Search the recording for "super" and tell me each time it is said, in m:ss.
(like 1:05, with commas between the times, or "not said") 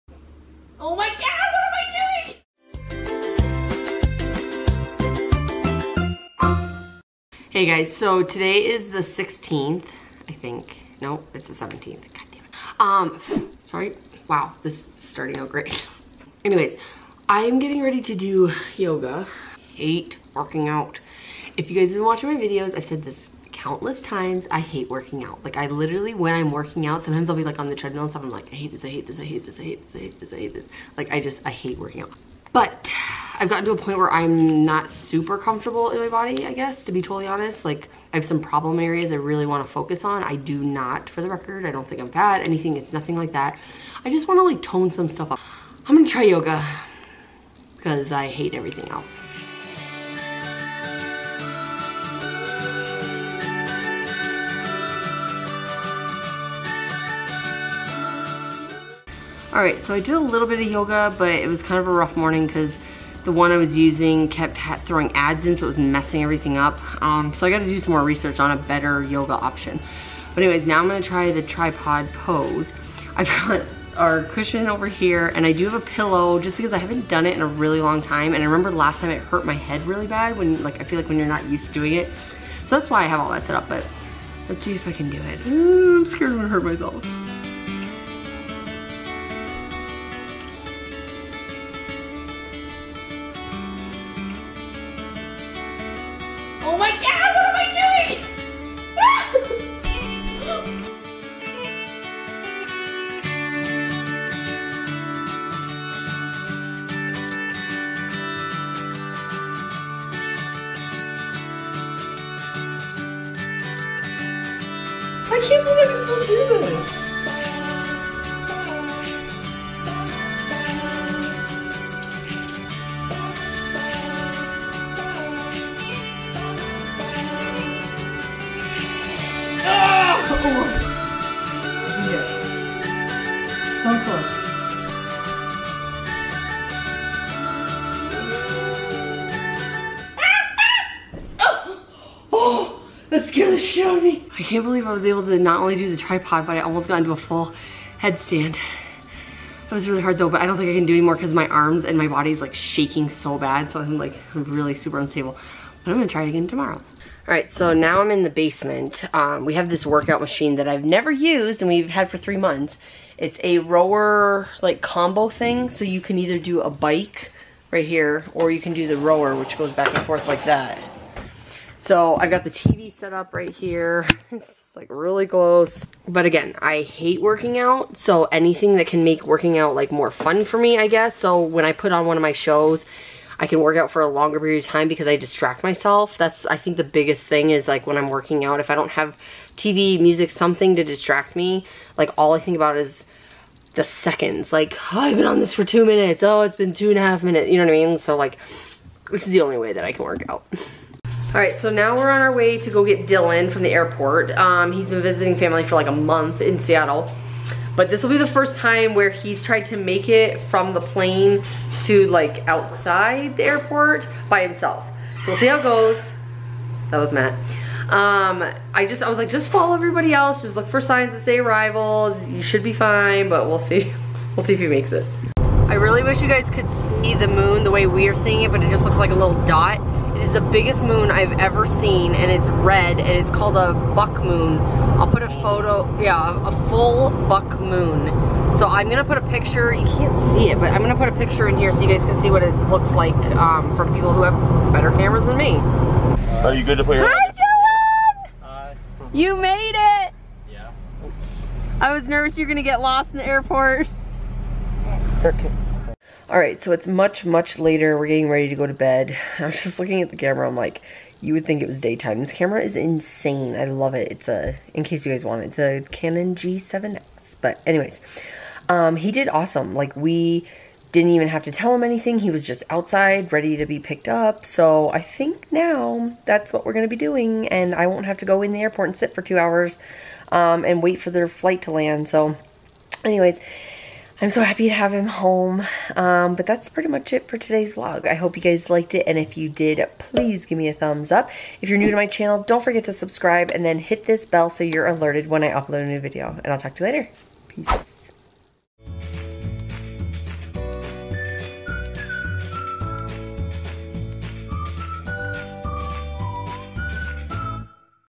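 0:34, 2:34.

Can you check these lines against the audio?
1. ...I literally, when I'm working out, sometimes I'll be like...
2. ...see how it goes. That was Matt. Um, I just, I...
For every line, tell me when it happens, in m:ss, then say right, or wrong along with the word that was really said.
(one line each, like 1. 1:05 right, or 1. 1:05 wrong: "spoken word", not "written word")
1. 0:25 right
2. 3:35 right.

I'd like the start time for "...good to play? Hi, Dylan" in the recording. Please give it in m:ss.
4:06.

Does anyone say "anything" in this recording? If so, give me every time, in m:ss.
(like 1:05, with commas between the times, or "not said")
0:42, 2:58, 4:31.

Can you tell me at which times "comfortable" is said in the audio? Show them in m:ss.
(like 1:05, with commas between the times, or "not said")
0:35.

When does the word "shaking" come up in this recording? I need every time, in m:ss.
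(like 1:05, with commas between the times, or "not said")
2:32.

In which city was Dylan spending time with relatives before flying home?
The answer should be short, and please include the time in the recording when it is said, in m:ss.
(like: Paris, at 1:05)
Seattle, at 3:26.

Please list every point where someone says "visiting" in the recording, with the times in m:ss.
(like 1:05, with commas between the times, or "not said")
3:25.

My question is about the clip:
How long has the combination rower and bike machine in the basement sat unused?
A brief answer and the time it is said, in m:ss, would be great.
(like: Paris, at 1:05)
3 months, at 2:42.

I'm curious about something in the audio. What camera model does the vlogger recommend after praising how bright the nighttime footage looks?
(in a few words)
Canon G7X.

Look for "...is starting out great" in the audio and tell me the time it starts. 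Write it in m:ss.
0:14.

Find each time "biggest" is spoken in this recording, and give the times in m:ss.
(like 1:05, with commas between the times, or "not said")
3:06, 3:50.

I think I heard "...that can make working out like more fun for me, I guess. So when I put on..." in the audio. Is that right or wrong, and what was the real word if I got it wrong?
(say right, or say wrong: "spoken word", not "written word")
right.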